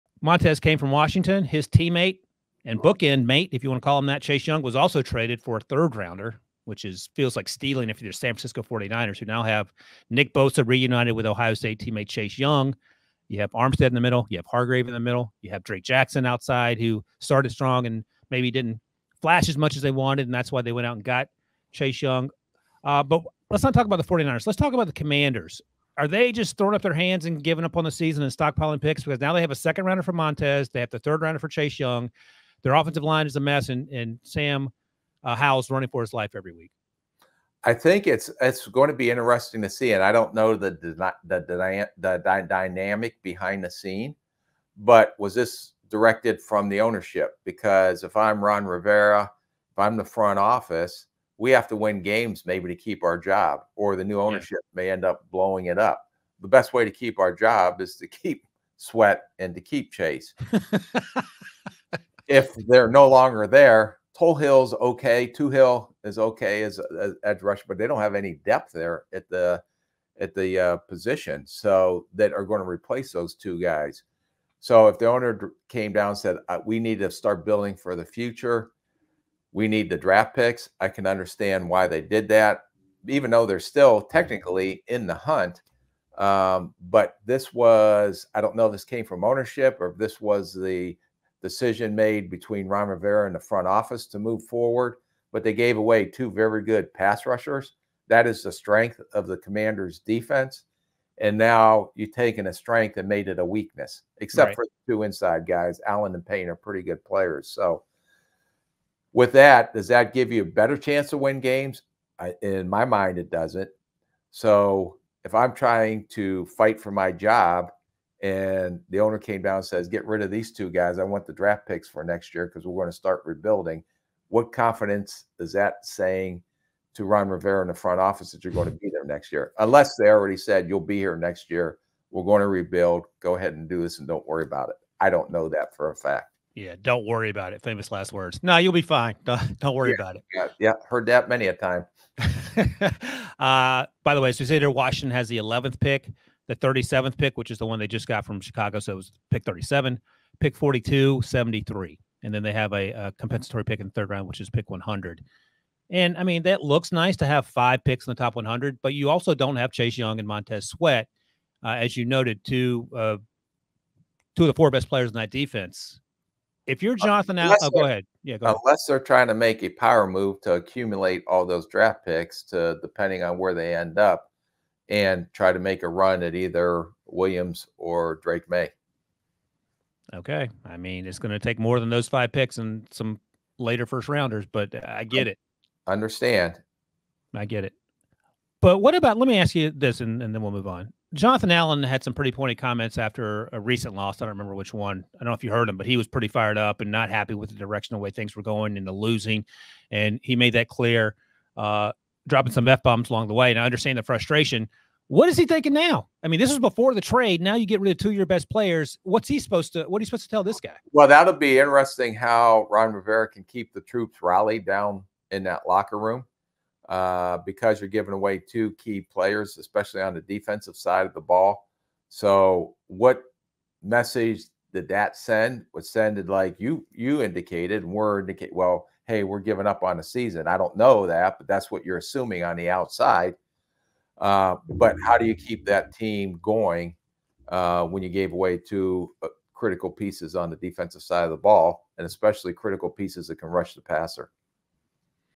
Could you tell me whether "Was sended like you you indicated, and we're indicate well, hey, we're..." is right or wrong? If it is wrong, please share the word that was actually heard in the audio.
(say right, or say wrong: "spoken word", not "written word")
right.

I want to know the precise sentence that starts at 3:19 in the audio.
And he made that clear, uh, dropping some F bombs along the way.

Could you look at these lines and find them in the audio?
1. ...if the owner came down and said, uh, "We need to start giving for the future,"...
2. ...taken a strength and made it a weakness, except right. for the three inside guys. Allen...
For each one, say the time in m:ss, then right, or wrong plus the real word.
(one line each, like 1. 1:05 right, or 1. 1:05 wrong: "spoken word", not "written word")
1. 1:14 wrong: "building", not "giving"
2. 1:42 wrong: "two", not "three".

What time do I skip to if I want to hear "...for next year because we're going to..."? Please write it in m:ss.
2:01.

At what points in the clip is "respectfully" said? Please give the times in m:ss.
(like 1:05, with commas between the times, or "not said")
not said.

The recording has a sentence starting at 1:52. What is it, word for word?
I, in my mind, it doesn't.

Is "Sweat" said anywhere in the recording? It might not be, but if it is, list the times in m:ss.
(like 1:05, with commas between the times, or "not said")
0:58, 2:40.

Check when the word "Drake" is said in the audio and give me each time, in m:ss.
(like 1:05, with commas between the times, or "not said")
0:15, 2:58.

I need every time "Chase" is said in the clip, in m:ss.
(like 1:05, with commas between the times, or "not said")
0:04, 0:12, 0:21, 0:31, 0:59, 2:39.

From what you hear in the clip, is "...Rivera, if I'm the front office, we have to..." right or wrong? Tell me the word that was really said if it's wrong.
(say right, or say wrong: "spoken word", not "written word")
right.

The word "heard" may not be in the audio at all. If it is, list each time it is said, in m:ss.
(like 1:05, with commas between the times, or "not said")
2:20, 3:15.